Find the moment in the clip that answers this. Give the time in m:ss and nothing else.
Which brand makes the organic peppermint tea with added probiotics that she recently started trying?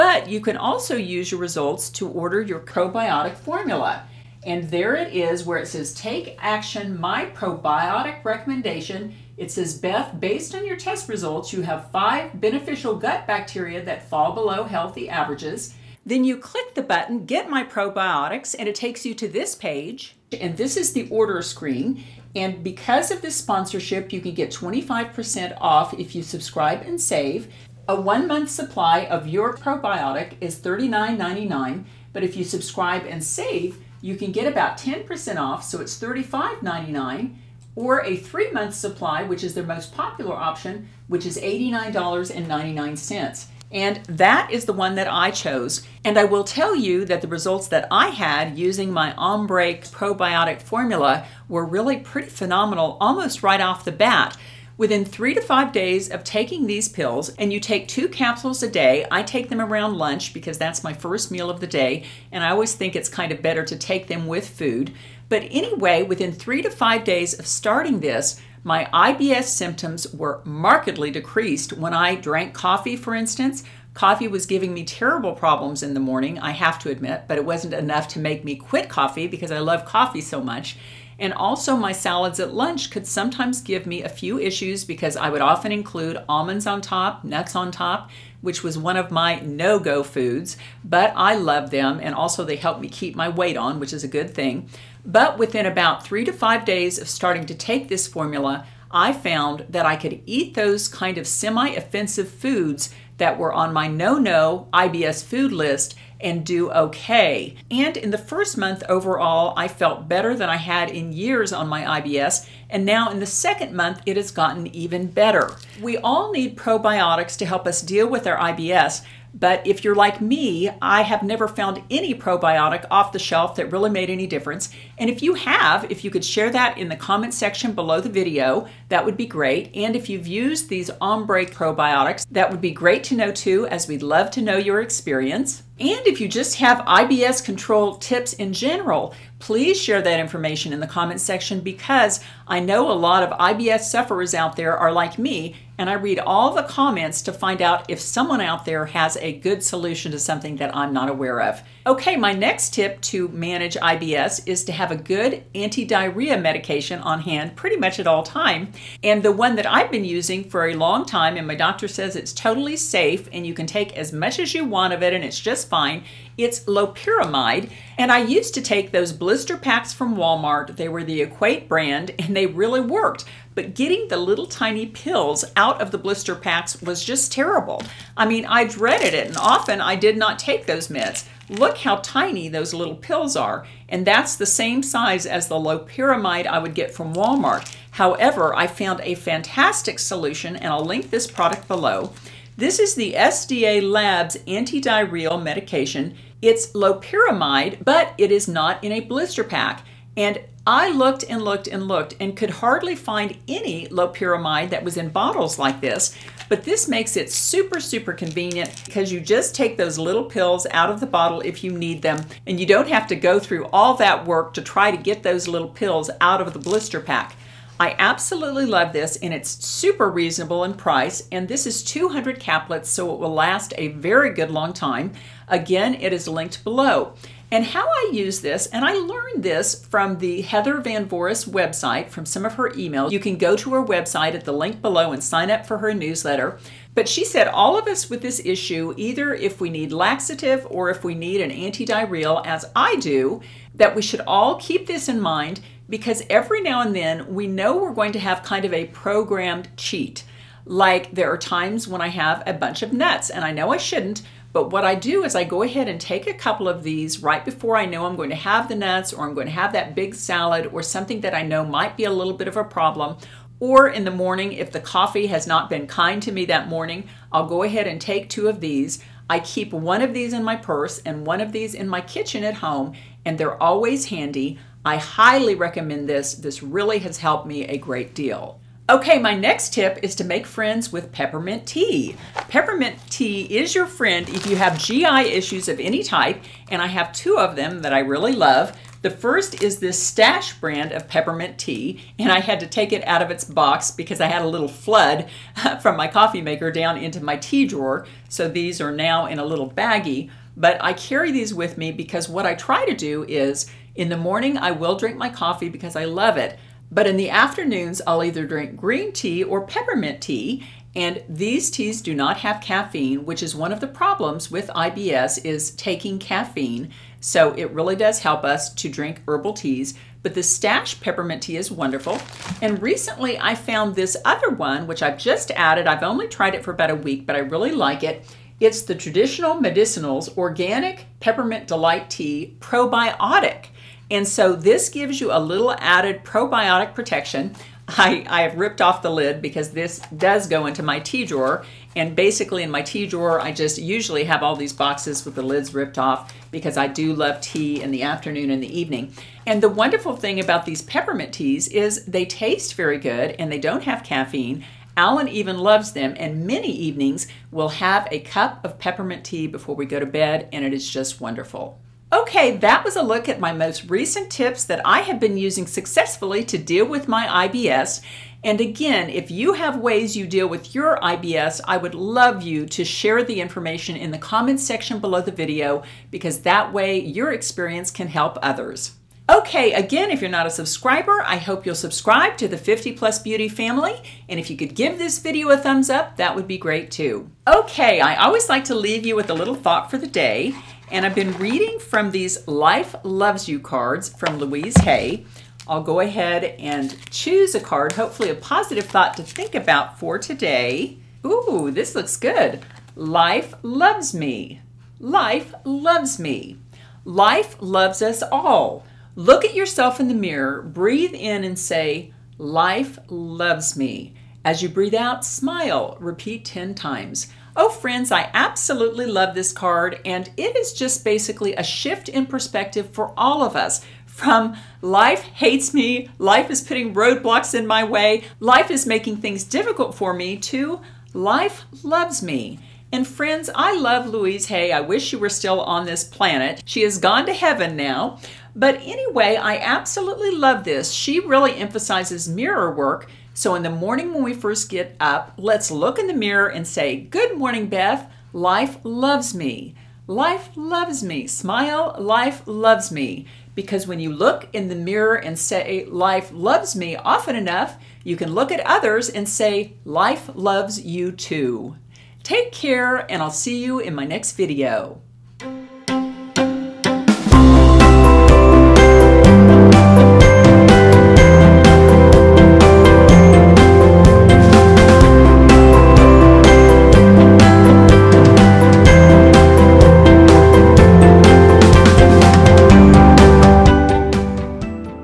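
5:28.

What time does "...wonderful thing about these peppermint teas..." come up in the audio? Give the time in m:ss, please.
5:49.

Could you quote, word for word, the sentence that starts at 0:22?
And because of this sponsorship, you can get 25% off if you subscribe and save.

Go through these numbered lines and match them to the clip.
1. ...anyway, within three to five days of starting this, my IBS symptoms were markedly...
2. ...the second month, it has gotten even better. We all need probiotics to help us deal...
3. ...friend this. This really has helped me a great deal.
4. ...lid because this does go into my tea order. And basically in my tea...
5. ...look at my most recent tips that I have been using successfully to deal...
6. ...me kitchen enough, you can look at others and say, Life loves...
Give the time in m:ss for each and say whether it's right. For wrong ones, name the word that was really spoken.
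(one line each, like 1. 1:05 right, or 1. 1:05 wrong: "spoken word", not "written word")
1. 1:05 right
2. 1:53 right
3. 4:35 wrong: "recommend", not "friend"
4. 5:39 wrong: "drawer", not "order"
5. 6:03 right
6. 7:36 wrong: "often", not "kitchen".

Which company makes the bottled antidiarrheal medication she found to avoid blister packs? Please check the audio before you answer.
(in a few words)
SDA Labs.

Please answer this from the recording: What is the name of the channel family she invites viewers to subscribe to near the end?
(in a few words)
50 Plus Beauty.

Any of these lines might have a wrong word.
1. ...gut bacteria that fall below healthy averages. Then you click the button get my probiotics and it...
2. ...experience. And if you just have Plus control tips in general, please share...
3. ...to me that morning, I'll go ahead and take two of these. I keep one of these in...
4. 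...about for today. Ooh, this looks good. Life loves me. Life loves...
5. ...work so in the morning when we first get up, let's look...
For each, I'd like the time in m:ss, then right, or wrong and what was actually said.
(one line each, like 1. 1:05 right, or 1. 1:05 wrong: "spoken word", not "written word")
1. 0:12 right
2. 2:14 wrong: "IBS", not "Plus"
3. 4:26 right
4. 6:39 right
5. 7:22 right.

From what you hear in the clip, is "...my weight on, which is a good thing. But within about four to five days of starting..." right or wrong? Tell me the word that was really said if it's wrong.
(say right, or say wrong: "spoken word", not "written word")
wrong: "three", not "four".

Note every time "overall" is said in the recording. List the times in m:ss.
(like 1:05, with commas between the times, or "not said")
1:48.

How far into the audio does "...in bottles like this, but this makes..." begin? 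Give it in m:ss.
3:24.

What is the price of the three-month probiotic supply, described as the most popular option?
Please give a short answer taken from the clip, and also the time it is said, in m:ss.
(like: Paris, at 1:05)
$89.99, at 0:41.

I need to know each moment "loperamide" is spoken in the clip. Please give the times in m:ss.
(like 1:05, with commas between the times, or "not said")
2:46, 3:05, 3:16, 3:23.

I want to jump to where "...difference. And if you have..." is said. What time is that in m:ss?
2:04.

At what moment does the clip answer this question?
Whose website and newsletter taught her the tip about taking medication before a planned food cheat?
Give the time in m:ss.
3:50.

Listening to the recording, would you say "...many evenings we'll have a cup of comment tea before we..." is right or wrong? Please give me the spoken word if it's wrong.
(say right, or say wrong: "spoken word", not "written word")
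wrong: "peppermint", not "comment".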